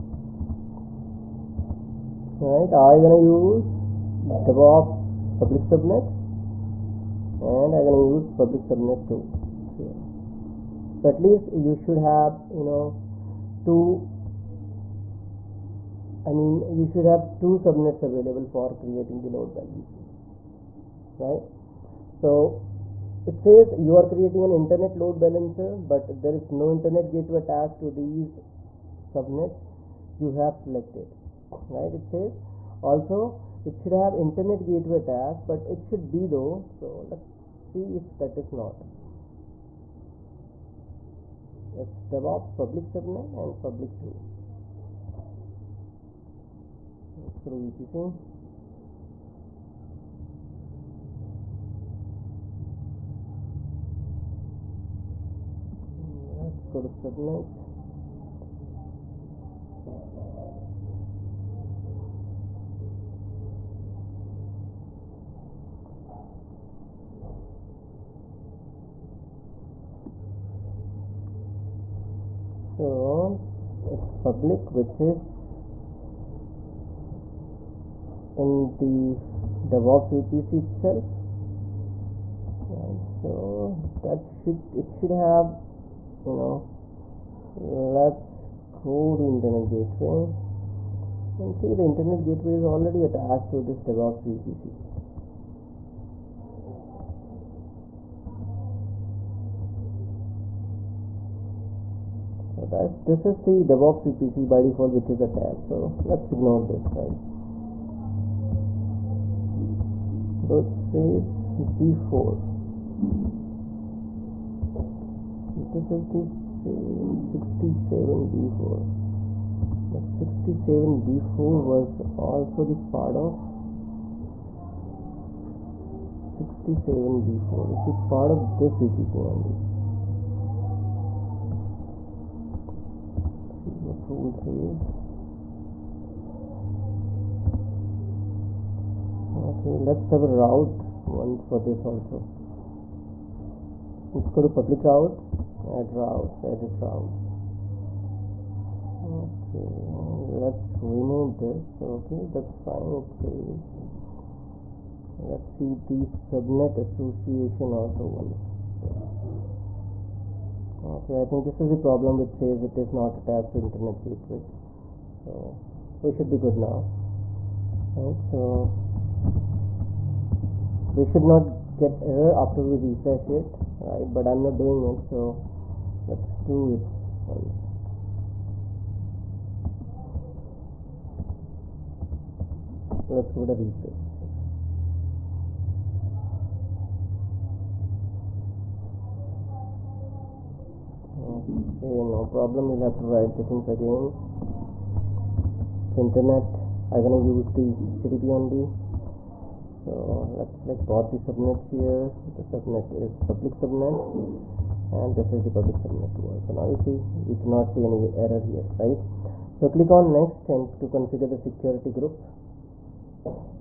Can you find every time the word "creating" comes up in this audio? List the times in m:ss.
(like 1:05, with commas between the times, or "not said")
0:18, 0:24.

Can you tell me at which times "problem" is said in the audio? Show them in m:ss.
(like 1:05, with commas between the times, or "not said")
2:41, 3:12.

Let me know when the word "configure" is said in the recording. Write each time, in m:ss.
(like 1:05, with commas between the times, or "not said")
3:30.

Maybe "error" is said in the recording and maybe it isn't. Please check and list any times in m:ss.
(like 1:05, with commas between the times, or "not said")
2:52, 3:28.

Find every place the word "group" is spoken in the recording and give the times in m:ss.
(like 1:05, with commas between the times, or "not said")
3:31.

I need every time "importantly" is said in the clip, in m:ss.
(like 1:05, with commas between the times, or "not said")
not said.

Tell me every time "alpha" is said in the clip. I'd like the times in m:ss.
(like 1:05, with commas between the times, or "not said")
not said.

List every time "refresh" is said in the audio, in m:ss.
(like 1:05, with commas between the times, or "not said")
2:52, 3:03.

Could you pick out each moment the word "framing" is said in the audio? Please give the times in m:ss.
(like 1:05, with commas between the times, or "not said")
not said.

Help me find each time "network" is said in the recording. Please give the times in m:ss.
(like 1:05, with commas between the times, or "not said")
not said.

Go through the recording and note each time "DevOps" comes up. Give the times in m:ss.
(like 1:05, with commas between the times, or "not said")
0:04, 0:42, 1:19, 1:33, 1:43.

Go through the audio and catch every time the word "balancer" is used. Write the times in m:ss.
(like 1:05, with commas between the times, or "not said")
0:19, 0:25.